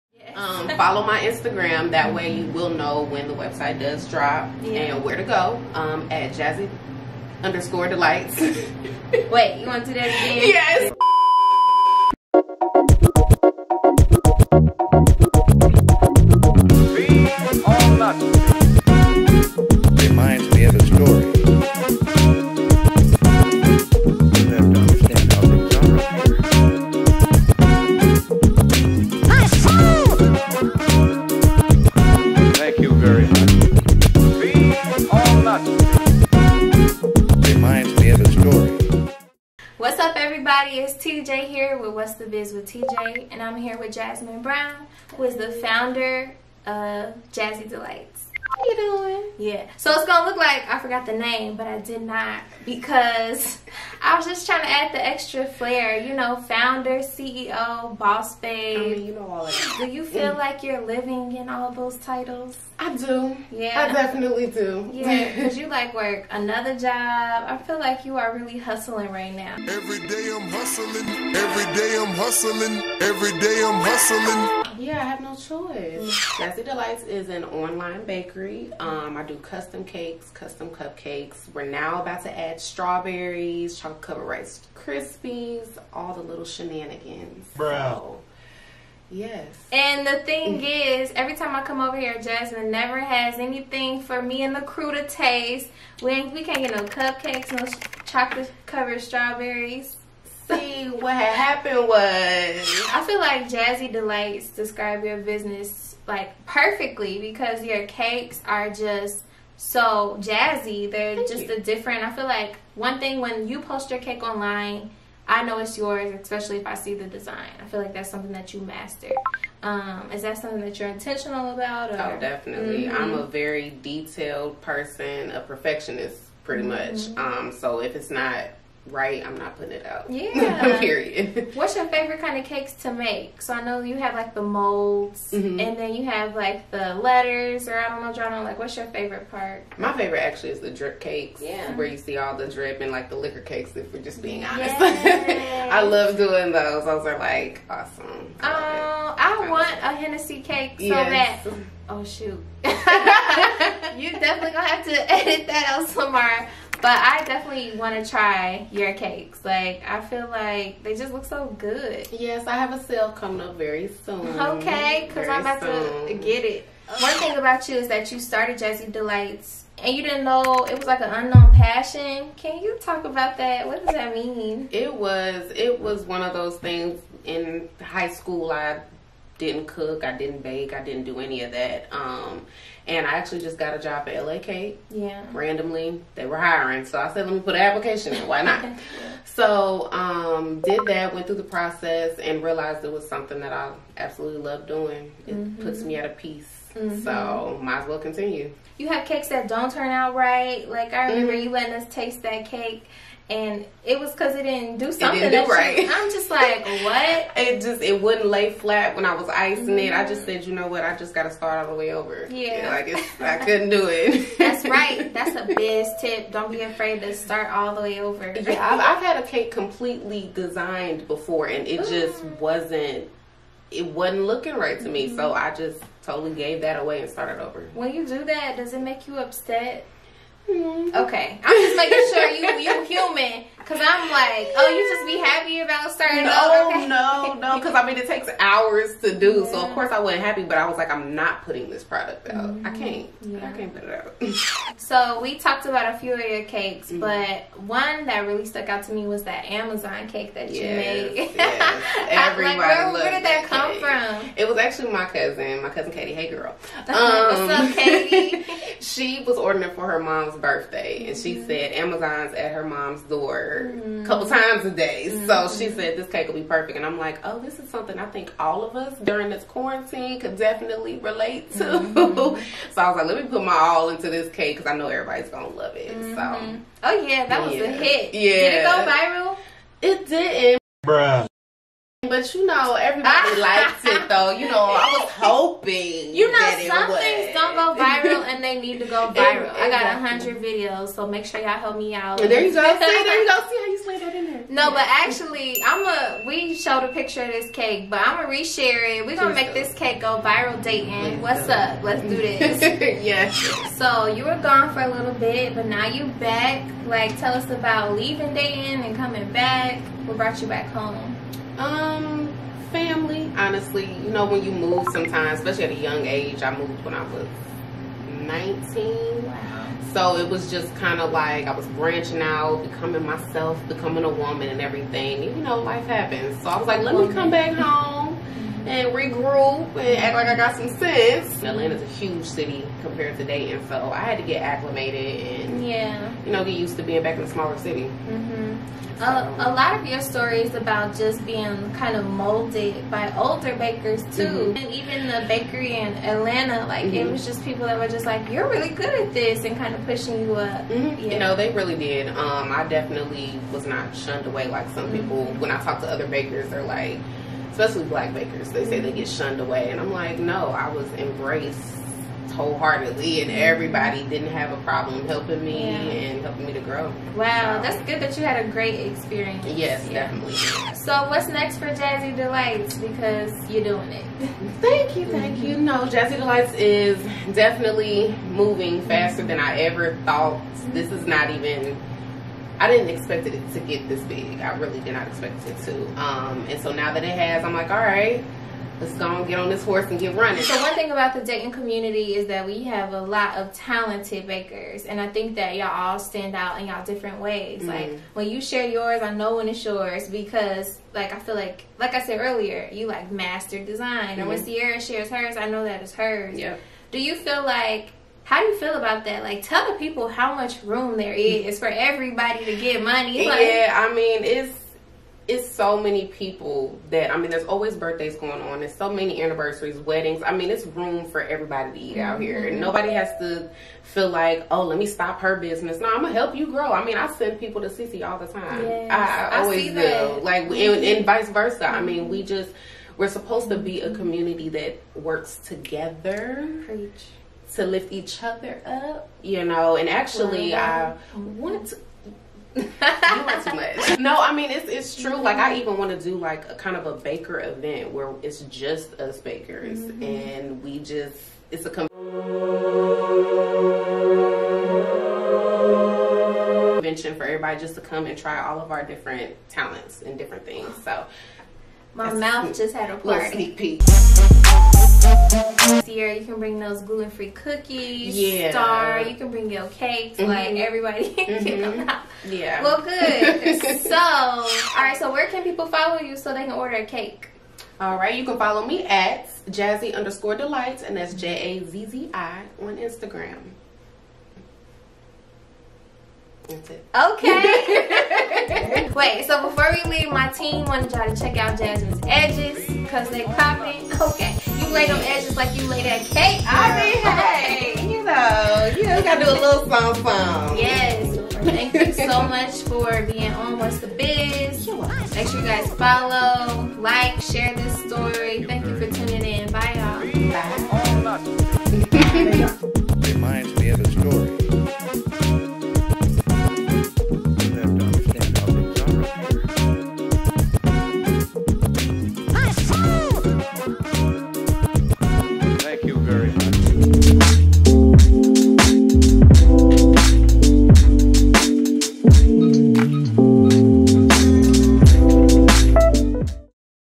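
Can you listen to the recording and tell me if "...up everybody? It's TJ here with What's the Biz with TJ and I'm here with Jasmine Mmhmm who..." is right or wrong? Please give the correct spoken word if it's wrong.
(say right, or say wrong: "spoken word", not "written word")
wrong: "Brown", not "Mmhmm".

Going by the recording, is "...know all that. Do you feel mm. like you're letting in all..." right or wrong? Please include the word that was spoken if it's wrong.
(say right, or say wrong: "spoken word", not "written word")
wrong: "living", not "letting".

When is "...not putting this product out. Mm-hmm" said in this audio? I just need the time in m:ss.
4:01.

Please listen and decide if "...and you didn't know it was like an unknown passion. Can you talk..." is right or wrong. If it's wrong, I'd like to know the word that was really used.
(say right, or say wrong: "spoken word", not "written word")
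right.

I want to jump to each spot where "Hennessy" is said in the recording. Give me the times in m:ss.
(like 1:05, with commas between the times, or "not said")
2:29.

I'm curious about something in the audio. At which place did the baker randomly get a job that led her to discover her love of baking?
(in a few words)
LA Kate.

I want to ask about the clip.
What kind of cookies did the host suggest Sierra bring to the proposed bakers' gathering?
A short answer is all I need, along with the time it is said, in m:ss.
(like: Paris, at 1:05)
gluten-free cookies, at 7:46.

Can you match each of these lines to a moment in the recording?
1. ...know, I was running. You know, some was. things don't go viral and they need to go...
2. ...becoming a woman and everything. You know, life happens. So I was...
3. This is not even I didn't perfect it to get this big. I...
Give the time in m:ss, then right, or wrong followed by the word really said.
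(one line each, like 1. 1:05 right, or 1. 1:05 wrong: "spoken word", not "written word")
1. 4:44 wrong: "hoping", not "running"
2. 5:23 right
3. 6:20 wrong: "expect", not "perfect".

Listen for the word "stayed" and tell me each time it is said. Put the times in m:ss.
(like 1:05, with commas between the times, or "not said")
not said.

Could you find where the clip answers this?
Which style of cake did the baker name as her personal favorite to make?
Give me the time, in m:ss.
2:20.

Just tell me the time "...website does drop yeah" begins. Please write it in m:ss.
0:03.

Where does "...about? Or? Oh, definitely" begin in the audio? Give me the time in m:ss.
2:01.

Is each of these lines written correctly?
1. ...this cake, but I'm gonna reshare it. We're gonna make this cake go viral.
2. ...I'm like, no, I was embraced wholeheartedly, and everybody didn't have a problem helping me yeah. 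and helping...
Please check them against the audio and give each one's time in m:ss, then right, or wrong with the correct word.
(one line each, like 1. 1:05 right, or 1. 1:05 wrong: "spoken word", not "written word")
1. 4:57 right
2. 5:59 right.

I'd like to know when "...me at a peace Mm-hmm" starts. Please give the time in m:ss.
3:15.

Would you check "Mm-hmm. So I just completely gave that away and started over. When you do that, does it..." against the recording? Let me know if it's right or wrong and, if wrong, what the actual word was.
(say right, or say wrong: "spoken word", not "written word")
wrong: "totally", not "completely".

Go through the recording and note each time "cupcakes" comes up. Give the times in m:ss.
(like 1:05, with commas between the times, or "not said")
1:20, 1:36.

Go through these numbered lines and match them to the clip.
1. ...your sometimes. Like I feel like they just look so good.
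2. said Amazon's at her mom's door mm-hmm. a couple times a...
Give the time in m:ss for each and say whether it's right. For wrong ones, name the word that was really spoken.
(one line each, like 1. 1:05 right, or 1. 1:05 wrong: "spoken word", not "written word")
1. 2:38 wrong: "cakes", not "sometimes"
2. 4:21 right.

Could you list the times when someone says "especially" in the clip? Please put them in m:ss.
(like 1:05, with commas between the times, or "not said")
1:56, 5:15, 5:57.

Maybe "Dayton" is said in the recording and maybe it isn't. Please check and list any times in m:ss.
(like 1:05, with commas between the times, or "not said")
5:00, 5:08, 5:33, 6:31.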